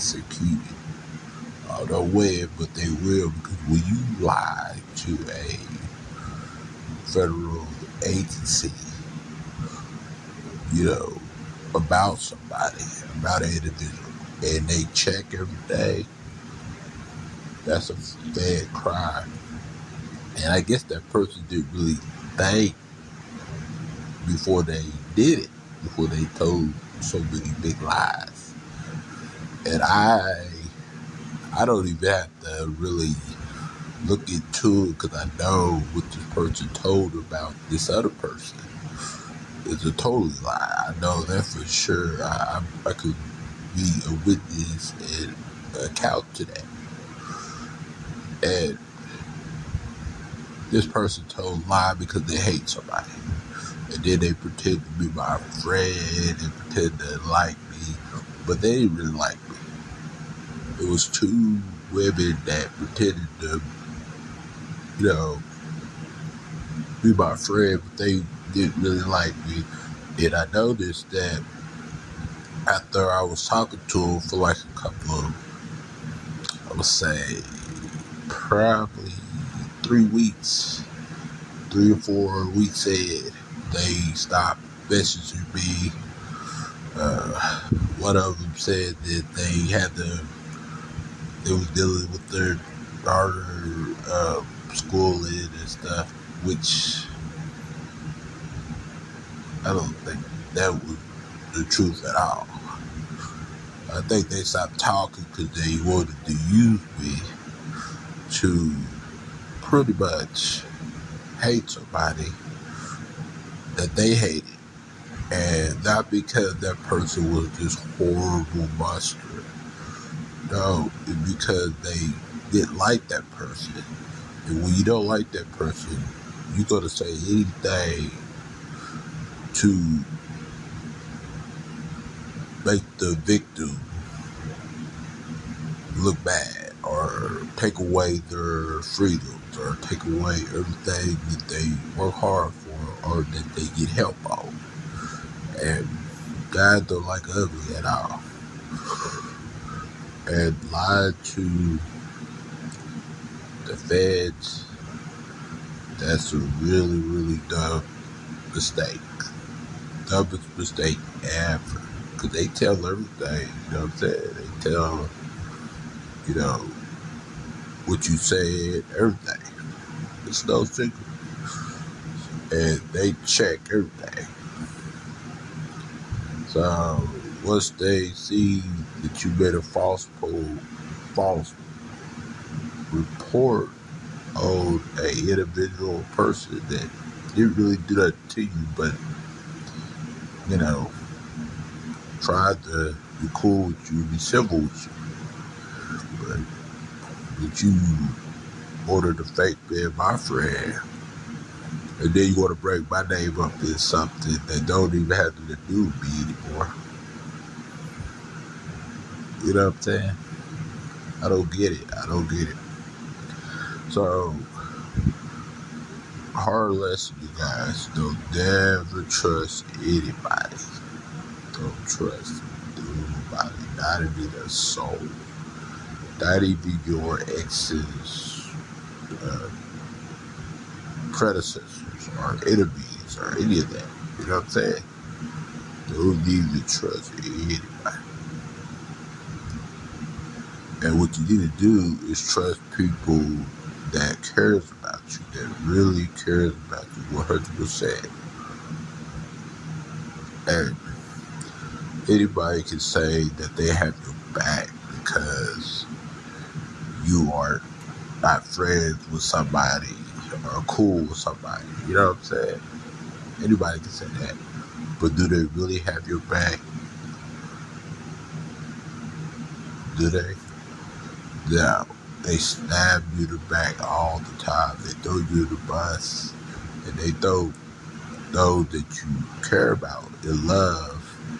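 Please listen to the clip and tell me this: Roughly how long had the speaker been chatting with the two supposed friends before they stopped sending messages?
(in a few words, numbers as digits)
3 or 4 weeks.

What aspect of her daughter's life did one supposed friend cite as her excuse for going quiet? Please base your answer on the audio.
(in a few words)
schooling.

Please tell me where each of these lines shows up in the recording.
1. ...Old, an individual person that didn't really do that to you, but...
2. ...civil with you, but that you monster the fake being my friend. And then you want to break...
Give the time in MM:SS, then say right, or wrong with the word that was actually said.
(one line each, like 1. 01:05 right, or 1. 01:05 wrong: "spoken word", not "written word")
1. 03:04 right
2. 03:14 wrong: "order", not "monster".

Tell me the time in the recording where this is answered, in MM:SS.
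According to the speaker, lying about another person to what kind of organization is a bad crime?
00:07.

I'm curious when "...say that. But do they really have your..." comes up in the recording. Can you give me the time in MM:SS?
04:23.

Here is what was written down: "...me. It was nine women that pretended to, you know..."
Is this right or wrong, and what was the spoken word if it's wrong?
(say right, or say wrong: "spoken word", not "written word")
wrong: "two", not "nine".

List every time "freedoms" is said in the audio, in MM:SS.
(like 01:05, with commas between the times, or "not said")
02:18.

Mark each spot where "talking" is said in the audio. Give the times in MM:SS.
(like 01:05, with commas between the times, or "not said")
01:13, 01:44.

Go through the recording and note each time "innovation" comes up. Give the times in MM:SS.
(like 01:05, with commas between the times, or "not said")
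not said.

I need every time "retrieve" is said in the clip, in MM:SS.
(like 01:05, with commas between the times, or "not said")
not said.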